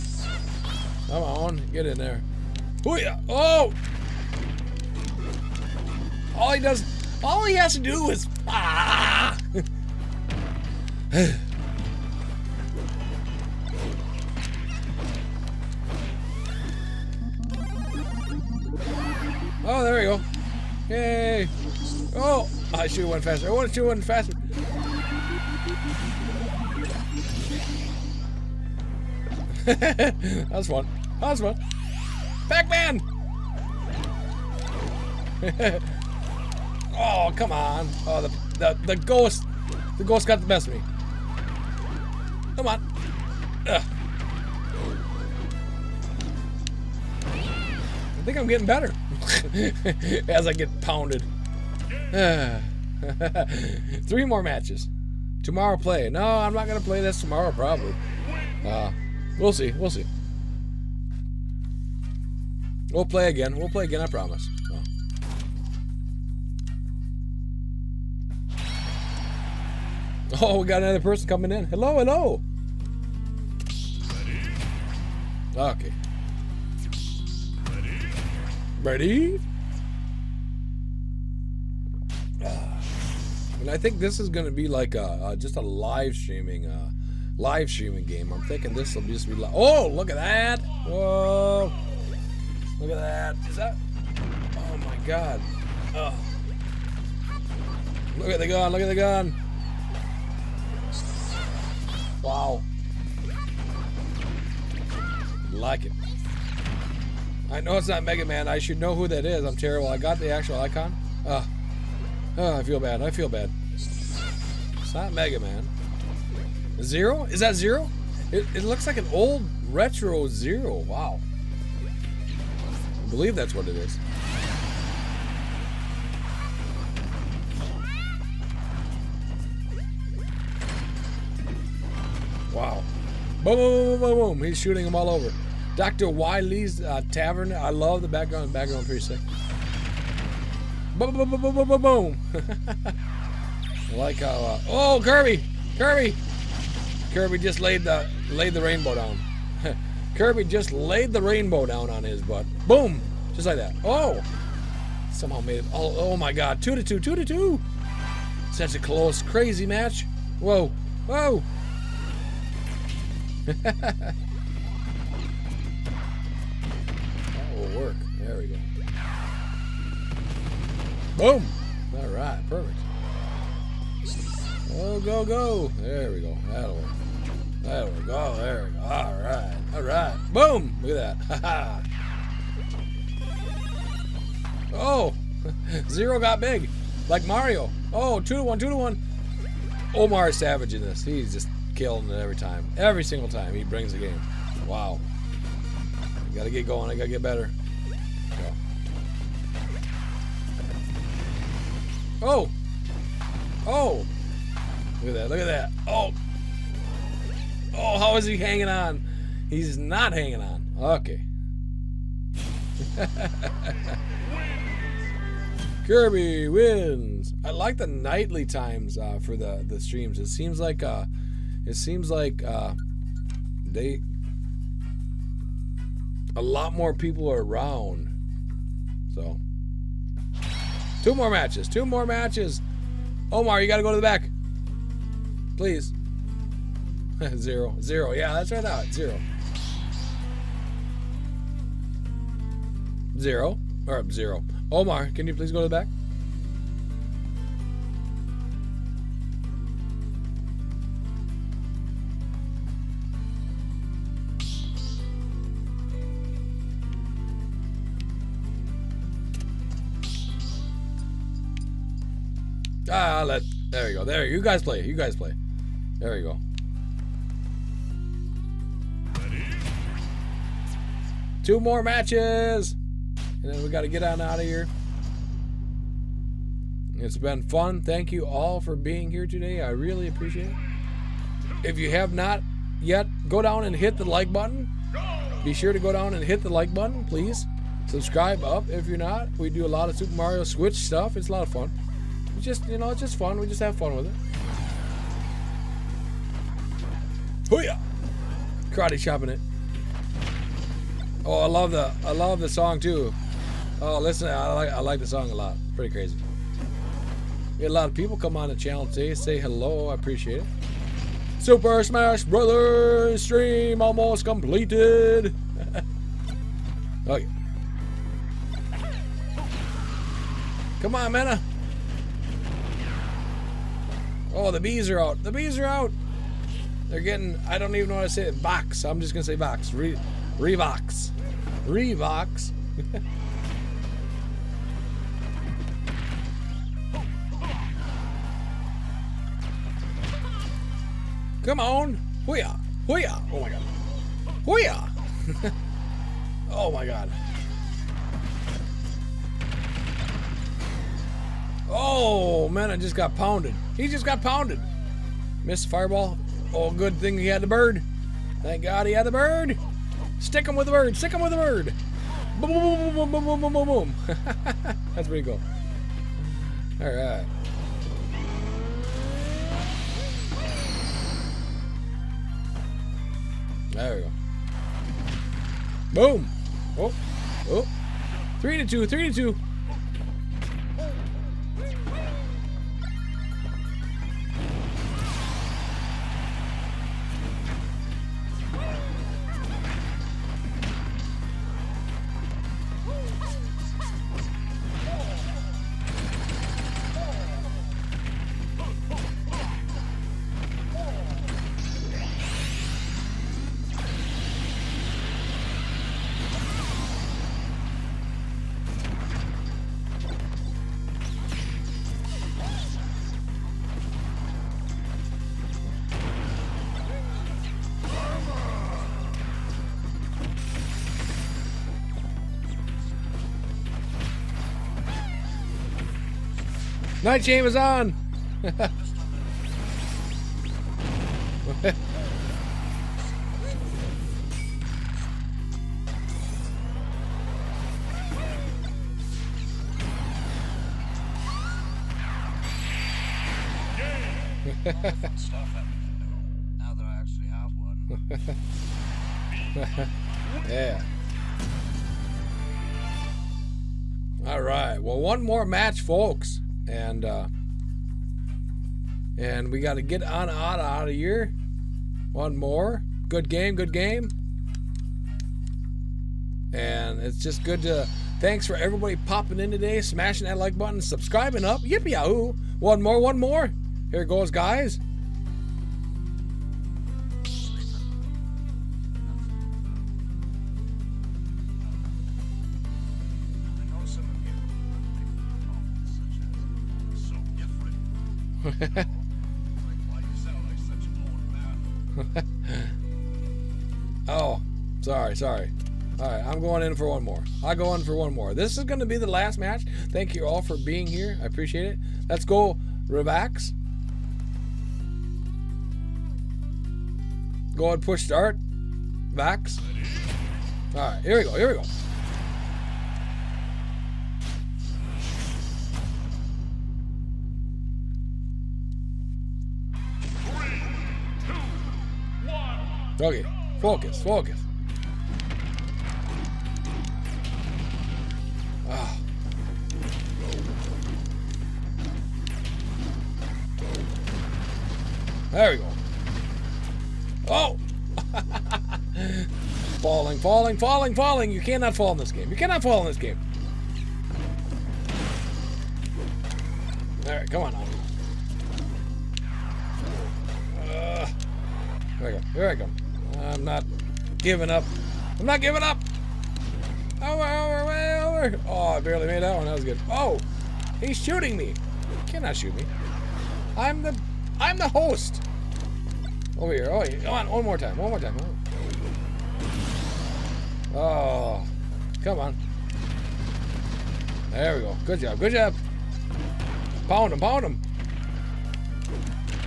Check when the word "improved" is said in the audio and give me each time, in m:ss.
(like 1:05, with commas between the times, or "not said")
not said.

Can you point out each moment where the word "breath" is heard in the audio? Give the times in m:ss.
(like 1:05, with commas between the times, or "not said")
not said.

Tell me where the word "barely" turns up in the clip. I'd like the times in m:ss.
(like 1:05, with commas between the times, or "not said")
9:18.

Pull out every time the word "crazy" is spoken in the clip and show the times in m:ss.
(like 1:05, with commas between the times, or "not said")
2:39, 5:05.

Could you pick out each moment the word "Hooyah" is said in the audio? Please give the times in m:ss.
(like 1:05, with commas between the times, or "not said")
4:57.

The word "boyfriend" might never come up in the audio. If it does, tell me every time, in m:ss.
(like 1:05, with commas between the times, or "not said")
not said.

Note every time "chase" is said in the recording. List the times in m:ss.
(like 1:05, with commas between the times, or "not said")
not said.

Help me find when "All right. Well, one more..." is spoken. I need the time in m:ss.
7:34.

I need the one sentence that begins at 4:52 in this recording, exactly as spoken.
We just, you know, it's just fun.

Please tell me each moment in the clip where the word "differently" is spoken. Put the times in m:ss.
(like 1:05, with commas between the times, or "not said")
not said.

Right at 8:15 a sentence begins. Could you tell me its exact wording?
All right, I'm going in for one more.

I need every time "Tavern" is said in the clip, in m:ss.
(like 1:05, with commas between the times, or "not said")
2:17.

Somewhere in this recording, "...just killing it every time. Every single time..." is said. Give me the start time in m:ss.
3:11.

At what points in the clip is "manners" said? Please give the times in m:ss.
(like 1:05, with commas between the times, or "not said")
not said.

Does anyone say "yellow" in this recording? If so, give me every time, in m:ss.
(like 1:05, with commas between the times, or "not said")
not said.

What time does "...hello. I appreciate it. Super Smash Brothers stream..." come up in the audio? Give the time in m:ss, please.
5:09.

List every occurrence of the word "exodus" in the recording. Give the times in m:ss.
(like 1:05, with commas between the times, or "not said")
not said.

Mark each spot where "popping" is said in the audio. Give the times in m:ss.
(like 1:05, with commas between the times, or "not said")
7:48.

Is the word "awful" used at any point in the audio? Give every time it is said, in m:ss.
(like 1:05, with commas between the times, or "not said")
not said.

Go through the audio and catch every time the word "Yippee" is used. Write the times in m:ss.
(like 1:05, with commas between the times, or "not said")
7:51.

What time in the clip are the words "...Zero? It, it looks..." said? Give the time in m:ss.
1:57.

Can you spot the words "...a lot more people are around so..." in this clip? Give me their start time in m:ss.
3:46.